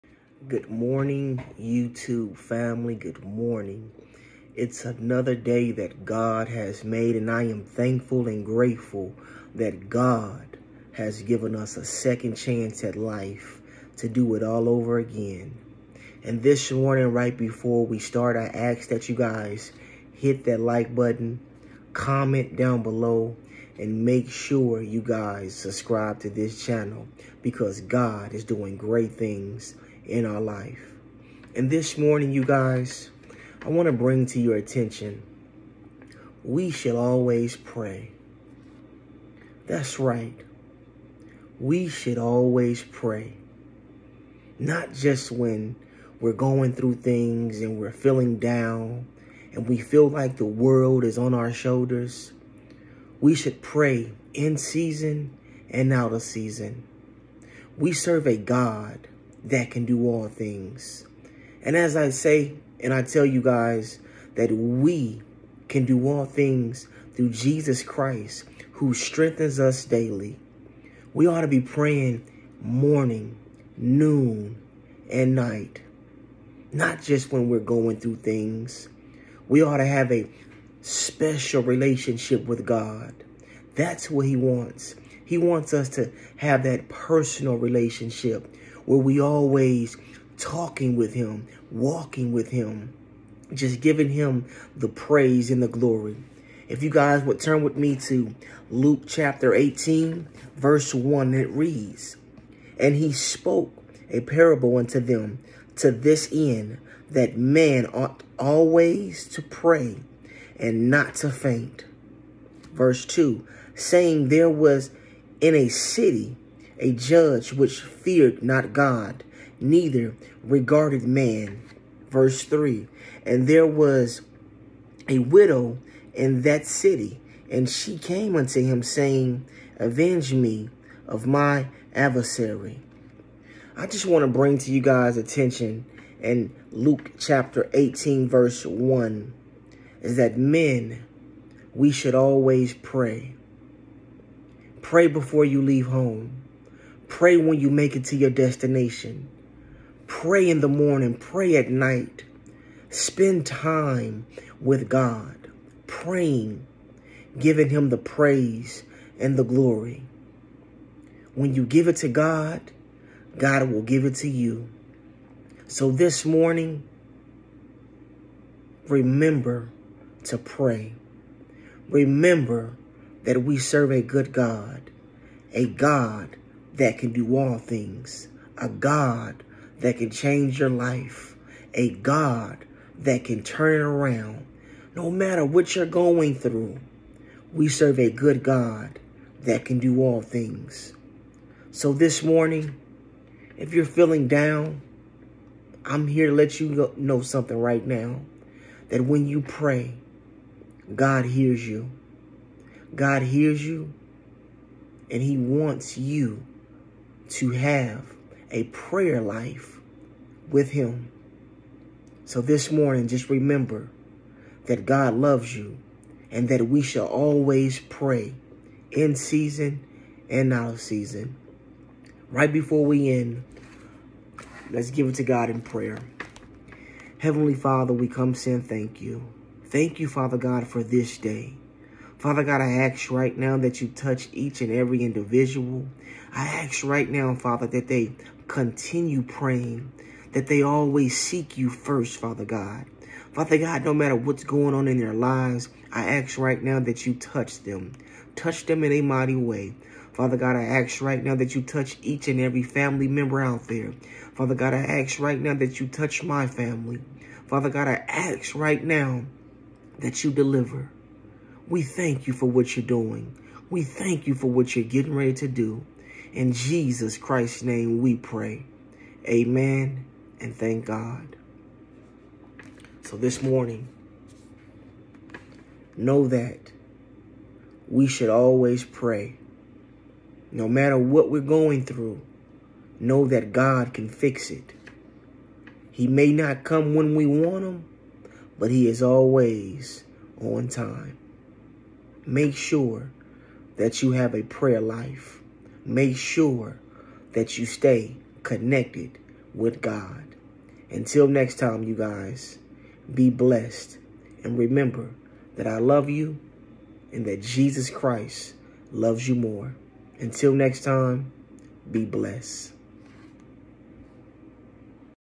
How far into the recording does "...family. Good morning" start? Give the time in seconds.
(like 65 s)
2 s.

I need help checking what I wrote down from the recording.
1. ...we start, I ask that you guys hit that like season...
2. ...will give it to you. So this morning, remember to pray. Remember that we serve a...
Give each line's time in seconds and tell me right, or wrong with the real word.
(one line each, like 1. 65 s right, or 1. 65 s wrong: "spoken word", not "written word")
1. 17 s wrong: "button", not "season"
2. 163 s right.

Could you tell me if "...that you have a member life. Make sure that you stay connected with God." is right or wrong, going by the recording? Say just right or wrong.
wrong.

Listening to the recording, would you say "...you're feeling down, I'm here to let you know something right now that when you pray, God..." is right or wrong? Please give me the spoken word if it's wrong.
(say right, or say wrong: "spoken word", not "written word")
right.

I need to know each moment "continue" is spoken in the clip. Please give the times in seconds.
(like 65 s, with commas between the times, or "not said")
238 s.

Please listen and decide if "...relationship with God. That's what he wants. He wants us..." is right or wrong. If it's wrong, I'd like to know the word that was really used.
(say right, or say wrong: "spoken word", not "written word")
right.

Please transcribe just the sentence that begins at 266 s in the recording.
In Jesus Christ's name we pray.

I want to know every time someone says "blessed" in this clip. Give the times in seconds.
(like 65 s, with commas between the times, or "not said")
303 s, 312 s.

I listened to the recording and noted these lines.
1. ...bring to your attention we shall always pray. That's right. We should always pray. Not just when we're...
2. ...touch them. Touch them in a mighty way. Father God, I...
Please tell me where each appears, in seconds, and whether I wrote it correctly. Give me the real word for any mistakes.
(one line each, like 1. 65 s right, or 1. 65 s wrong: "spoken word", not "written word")
1. 33 s right
2. 247 s right.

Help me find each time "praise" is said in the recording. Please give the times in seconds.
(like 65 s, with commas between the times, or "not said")
94 s, 157 s.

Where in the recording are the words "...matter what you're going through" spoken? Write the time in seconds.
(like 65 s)
185 s.